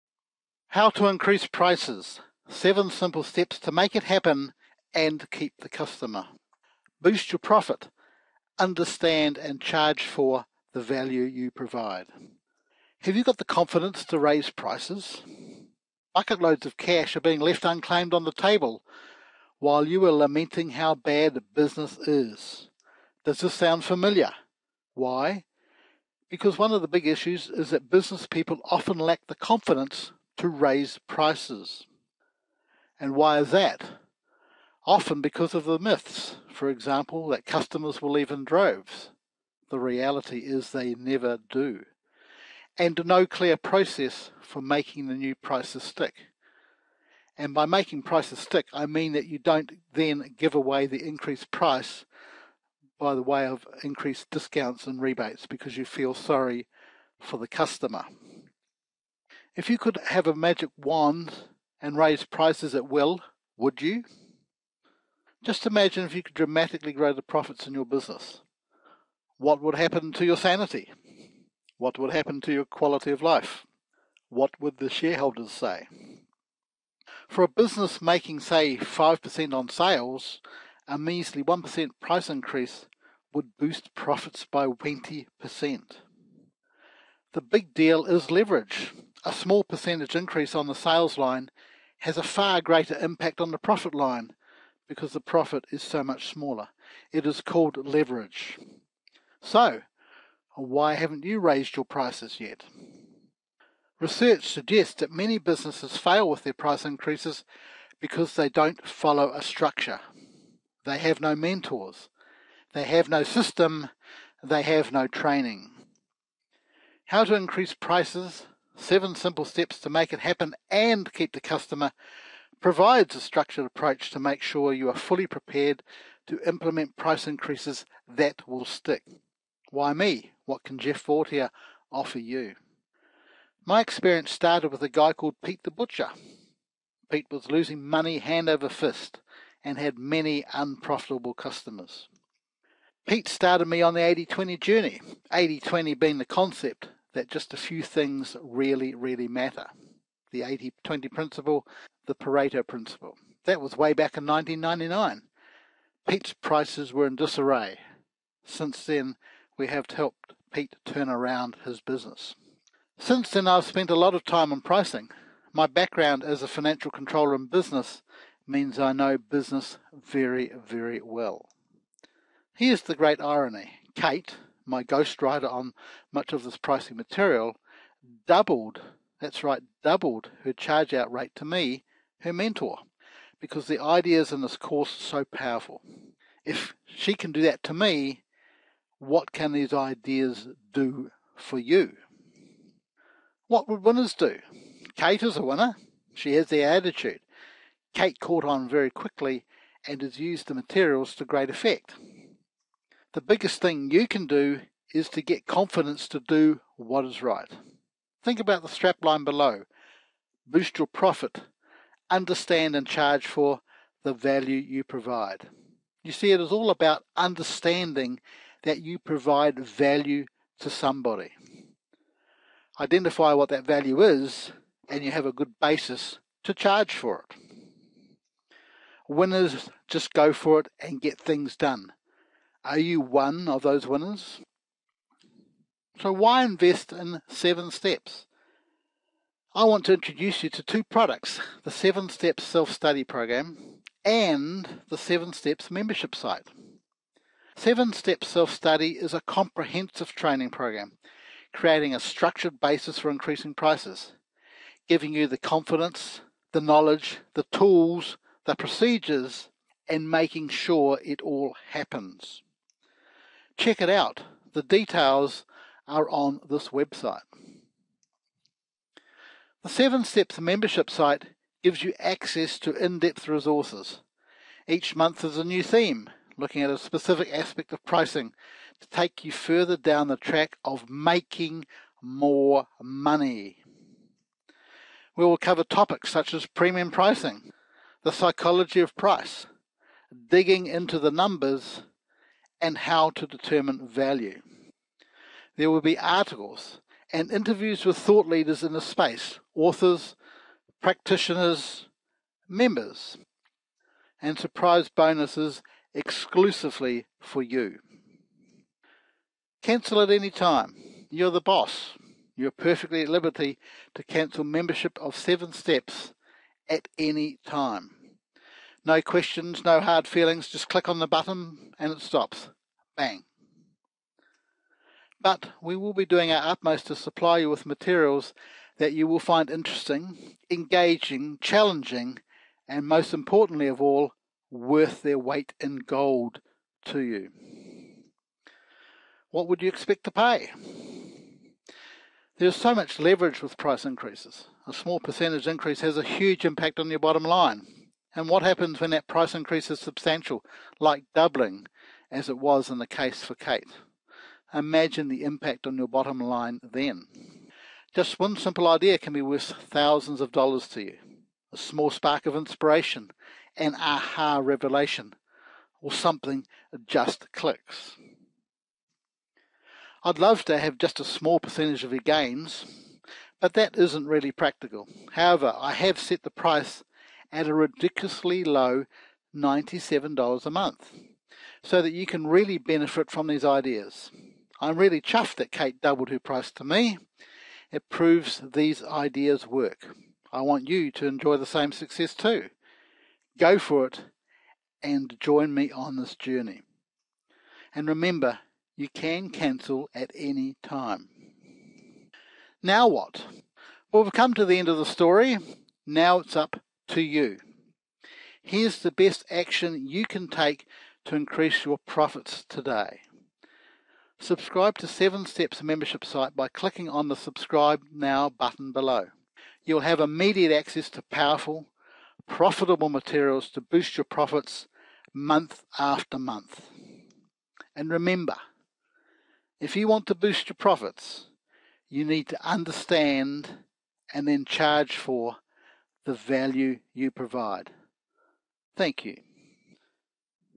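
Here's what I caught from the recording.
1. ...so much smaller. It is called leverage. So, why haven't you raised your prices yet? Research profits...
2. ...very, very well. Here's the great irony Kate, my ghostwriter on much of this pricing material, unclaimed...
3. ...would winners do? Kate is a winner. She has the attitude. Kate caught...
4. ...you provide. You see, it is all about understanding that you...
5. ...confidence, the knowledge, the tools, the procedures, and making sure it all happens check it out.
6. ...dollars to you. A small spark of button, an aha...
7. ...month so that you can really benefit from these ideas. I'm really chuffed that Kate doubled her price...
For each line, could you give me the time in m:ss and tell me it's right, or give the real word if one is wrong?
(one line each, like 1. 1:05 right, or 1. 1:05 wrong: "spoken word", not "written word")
1. 1:35 wrong: "suggests", not "profits"
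2. 2:49 wrong: "doubled", not "unclaimed"
3. 3:13 right
4. 3:34 right
5. 4:15 right
6. 6:00 wrong: "inspiration", not "button"
7. 6:20 right.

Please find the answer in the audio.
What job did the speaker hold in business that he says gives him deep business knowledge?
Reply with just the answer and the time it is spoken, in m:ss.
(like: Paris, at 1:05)
financial controller, at 2:46.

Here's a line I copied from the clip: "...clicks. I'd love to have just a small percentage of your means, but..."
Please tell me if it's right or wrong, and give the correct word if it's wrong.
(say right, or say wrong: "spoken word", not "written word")
wrong: "gains", not "means".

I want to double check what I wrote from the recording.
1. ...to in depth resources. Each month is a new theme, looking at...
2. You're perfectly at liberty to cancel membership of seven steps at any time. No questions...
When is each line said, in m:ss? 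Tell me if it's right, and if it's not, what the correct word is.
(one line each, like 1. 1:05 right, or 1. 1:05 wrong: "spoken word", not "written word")
1. 4:32 right
2. 5:12 right.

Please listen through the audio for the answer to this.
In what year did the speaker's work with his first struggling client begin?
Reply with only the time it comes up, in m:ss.
2:34.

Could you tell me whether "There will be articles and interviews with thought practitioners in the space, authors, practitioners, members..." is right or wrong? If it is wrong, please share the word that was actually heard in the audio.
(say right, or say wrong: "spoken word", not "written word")
wrong: "leaders", not "practitioners".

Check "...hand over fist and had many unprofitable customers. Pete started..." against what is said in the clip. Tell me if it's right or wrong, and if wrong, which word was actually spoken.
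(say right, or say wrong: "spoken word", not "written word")
right.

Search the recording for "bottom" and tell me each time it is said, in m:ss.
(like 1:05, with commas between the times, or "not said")
5:46, 5:55.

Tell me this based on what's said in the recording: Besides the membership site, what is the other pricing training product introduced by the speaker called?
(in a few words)
Seven Steps Self Study Program.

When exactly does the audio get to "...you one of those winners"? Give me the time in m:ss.
3:52.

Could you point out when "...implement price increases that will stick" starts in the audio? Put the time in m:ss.
2:06.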